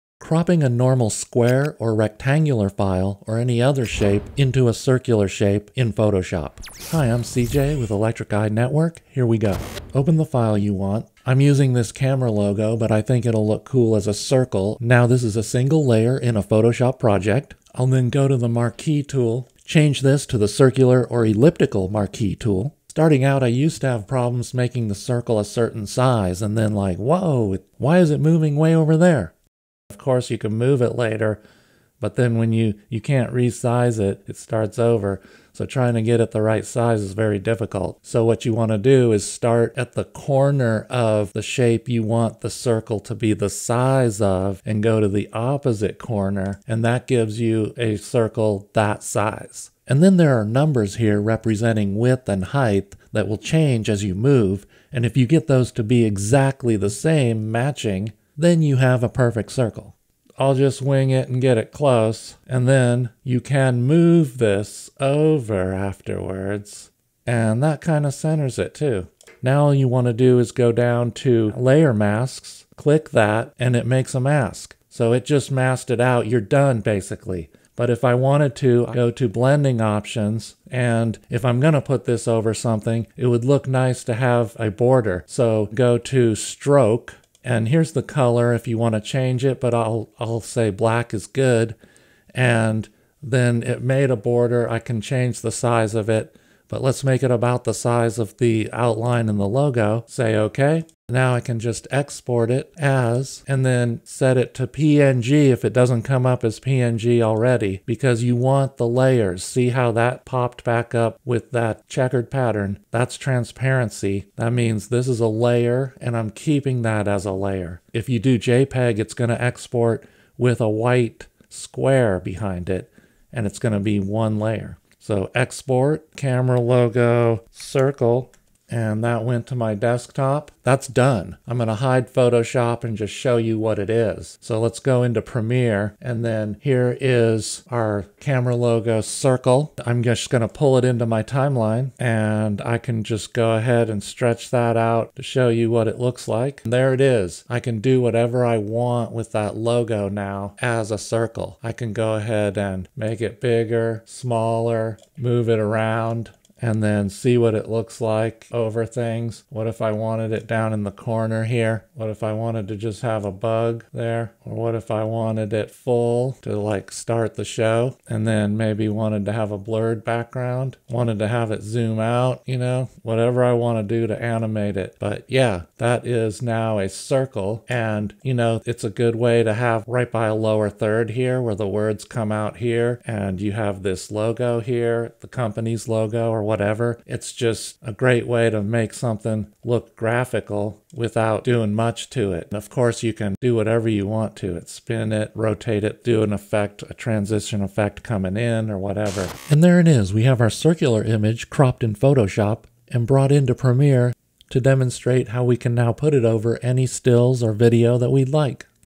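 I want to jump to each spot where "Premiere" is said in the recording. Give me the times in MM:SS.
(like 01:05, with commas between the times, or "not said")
02:15, 03:23.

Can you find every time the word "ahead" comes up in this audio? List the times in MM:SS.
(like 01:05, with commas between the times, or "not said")
02:23, 02:32.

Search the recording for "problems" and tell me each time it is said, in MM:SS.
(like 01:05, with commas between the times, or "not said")
00:24.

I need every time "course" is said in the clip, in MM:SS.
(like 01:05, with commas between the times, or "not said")
00:30, 03:12.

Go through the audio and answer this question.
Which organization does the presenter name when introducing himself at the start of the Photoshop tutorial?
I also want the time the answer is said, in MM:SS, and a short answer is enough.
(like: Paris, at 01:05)
Electric Eye Network, at 00:07.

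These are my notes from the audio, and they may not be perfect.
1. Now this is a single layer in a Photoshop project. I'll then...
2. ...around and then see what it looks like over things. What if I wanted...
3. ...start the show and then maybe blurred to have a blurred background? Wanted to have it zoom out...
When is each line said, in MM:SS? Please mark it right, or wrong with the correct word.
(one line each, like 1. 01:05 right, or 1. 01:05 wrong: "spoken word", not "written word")
1. 00:14 right
2. 02:35 right
3. 02:46 wrong: "wanted", not "blurred".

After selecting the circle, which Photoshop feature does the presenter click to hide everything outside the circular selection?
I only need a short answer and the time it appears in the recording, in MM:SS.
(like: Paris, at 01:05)
layer masks, at 01:11.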